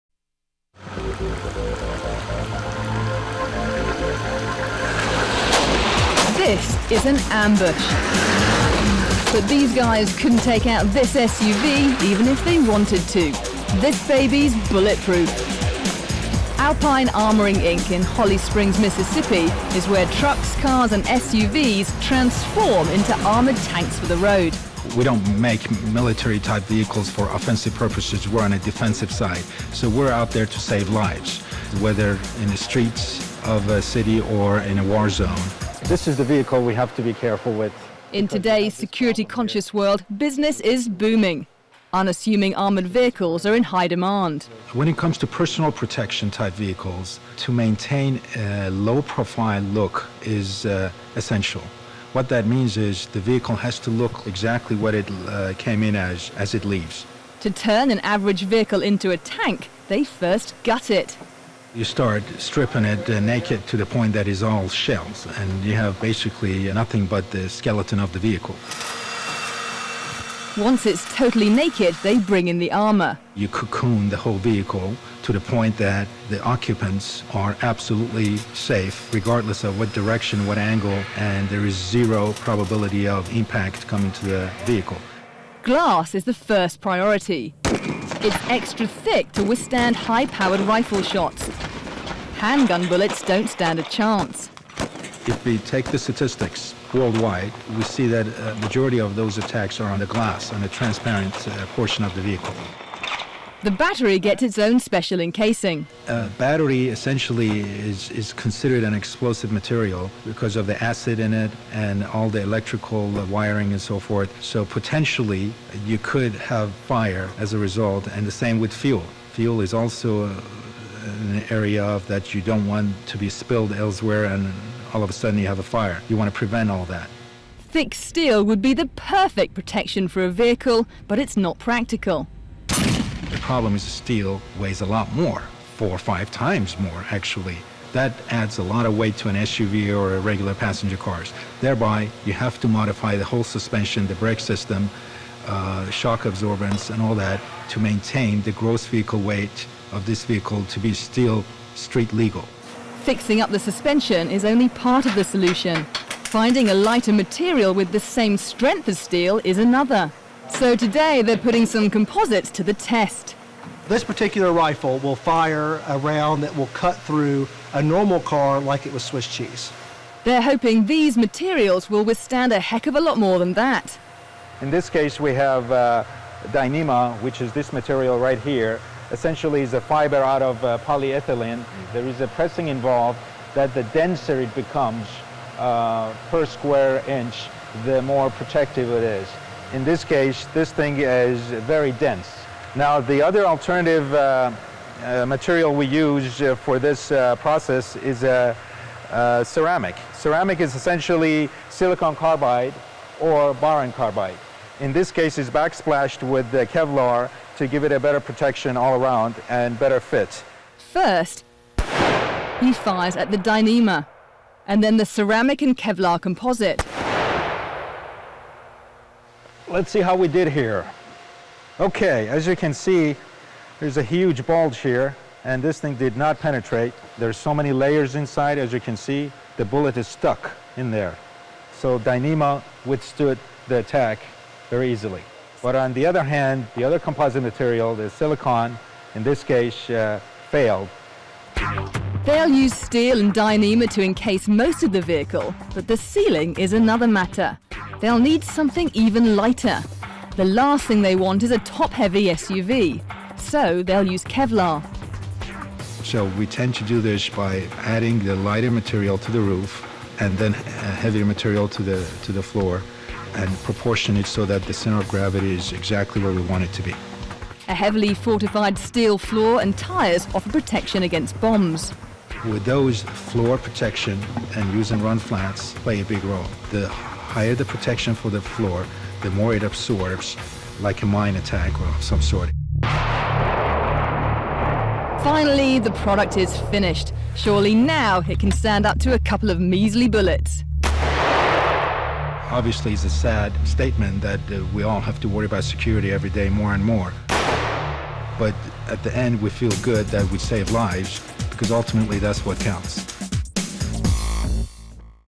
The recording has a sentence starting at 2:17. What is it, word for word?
That adds a lot of weight to an SUV or a regular passenger cars.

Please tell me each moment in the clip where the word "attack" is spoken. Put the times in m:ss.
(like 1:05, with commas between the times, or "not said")
1:39, 3:53, 4:41.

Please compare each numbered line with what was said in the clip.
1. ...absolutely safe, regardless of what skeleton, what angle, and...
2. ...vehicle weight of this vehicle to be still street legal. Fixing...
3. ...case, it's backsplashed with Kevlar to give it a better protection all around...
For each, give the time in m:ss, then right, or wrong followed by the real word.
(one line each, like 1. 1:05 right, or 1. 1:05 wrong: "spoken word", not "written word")
1. 1:17 wrong: "direction", not "skeleton"
2. 2:28 right
3. 3:25 right.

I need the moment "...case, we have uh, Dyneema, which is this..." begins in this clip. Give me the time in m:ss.
2:54.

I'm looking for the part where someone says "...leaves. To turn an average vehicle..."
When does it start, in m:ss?
0:56.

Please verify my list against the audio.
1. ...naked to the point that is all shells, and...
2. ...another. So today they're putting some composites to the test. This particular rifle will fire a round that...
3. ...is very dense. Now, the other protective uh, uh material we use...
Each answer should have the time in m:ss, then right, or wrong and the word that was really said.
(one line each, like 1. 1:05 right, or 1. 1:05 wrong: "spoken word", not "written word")
1. 1:03 right
2. 2:39 right
3. 3:10 wrong: "alternative", not "protective".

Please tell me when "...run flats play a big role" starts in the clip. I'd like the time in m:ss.
4:35.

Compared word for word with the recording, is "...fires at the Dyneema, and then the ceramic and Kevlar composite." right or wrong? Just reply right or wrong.
right.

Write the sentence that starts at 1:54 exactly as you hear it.
So potentially you could have fire as a result, and the same with fuel.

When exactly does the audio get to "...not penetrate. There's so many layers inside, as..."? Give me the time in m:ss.
3:46.